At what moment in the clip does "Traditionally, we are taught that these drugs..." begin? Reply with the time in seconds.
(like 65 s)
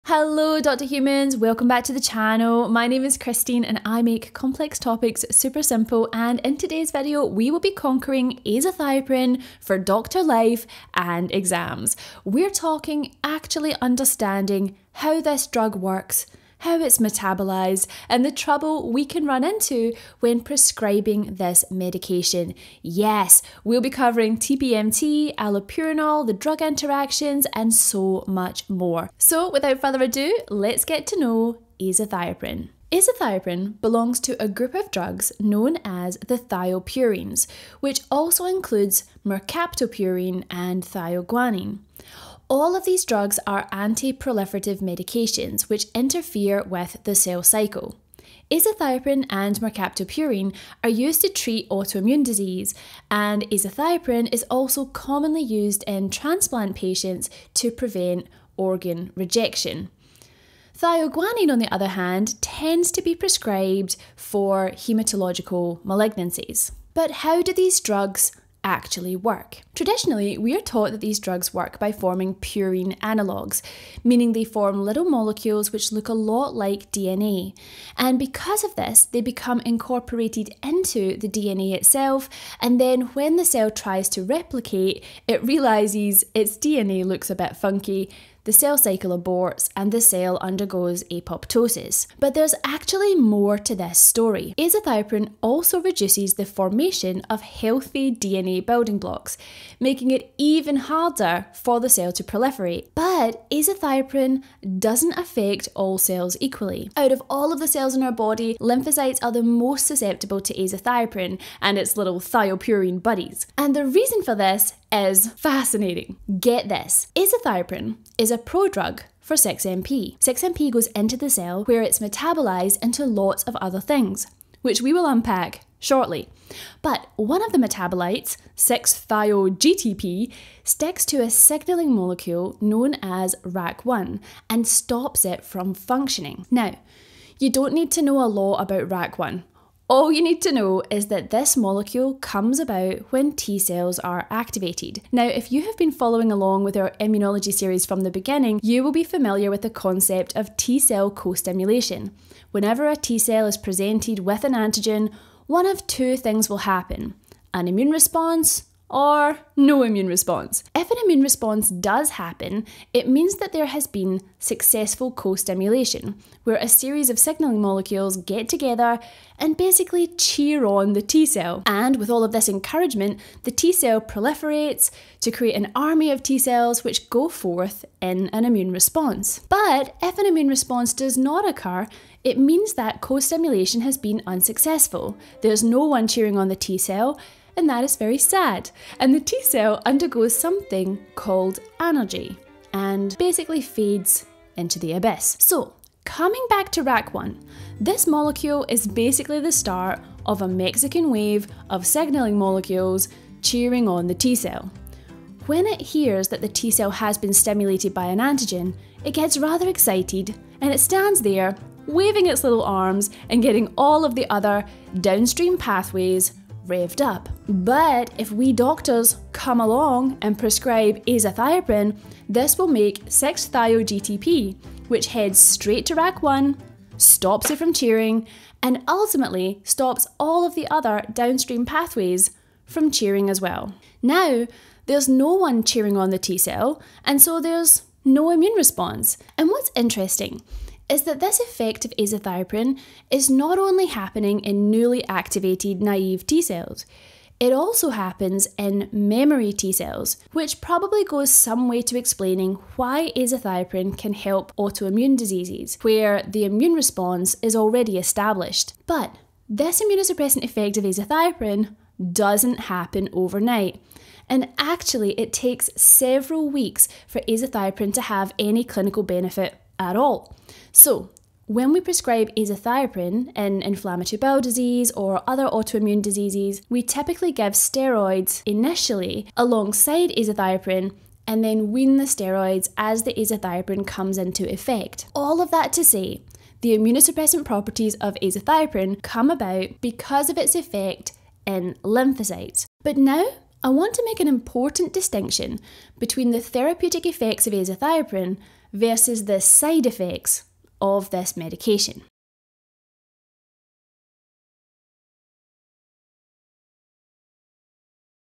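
69 s.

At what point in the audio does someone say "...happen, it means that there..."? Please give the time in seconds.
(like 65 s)
162 s.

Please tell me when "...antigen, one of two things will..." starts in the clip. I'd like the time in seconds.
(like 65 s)
154 s.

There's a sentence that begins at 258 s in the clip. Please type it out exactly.
But this immunosuppressant effect of azathioprine doesn't happen overnight.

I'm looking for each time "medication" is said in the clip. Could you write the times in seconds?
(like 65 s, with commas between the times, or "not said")
21 s, 44 s, 301 s.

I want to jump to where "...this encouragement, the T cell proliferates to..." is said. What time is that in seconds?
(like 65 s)
172 s.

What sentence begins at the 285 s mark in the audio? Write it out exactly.
All of that to say, the immunosuppressant properties of azathioprine come about because of its effect in lymphocytes.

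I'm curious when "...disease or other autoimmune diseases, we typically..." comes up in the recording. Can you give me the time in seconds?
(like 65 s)
274 s.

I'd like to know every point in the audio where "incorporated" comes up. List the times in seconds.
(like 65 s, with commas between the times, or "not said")
79 s.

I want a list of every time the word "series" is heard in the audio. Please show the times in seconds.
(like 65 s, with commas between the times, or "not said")
147 s, 166 s.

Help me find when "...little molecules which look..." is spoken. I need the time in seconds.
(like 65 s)
74 s.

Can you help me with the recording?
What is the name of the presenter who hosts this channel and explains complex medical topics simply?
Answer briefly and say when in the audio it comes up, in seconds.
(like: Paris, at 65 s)
Kristeen, at 3 s.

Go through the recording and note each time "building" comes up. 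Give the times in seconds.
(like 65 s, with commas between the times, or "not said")
98 s.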